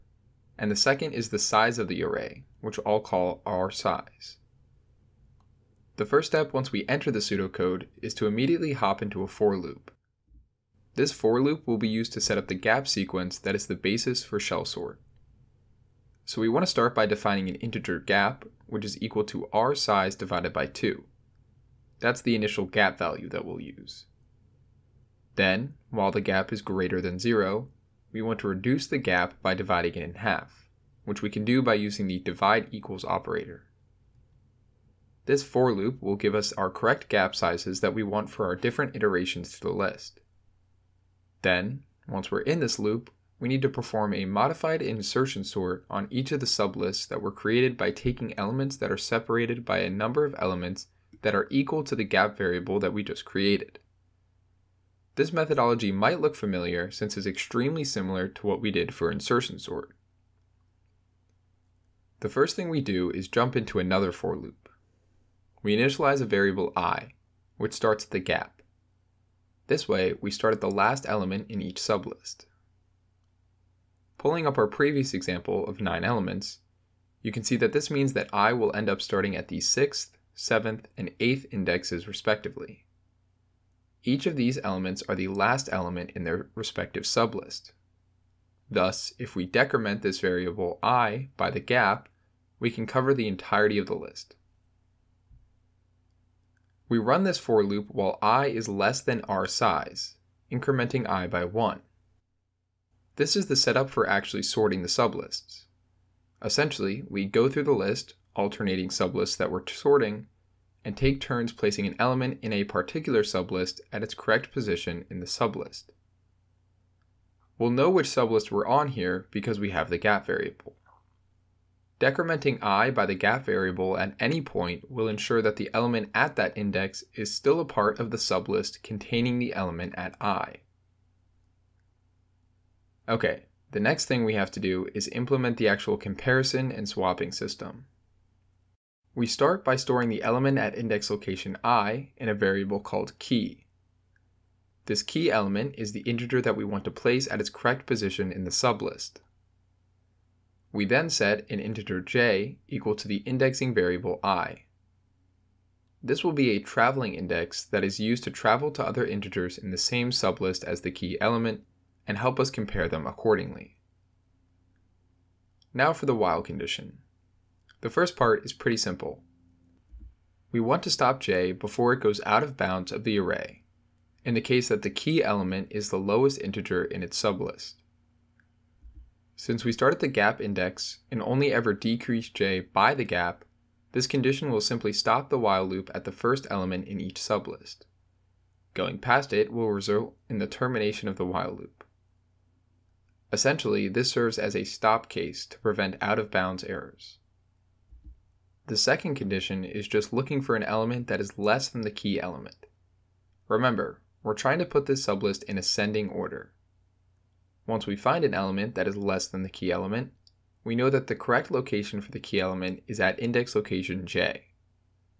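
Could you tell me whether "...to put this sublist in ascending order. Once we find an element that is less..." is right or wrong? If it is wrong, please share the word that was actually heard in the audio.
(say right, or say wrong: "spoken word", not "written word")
right.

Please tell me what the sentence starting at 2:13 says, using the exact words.
Okay, the next thing we have to do is implement the actual comparison and swapping system.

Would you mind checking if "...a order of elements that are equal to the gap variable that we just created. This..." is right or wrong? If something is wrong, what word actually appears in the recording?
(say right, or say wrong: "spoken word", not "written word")
wrong: "number", not "order".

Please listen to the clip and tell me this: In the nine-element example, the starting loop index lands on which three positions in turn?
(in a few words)
6th, 7th, and 8th.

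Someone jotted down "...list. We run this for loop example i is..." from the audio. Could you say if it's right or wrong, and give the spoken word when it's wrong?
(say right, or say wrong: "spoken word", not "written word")
wrong: "while", not "example".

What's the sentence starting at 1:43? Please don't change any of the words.
This is the setup for actually sorting the sublists.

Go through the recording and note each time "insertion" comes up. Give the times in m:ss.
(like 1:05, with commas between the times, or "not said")
0:44, 0:59.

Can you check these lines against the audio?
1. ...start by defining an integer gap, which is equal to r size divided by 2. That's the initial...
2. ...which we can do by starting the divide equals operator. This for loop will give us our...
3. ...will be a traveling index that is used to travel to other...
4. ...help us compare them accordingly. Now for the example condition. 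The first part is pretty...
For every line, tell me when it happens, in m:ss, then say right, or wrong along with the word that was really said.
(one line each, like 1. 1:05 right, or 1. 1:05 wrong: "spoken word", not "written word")
1. 0:16 right
2. 0:31 wrong: "using", not "starting"
3. 2:36 right
4. 2:42 wrong: "while", not "example".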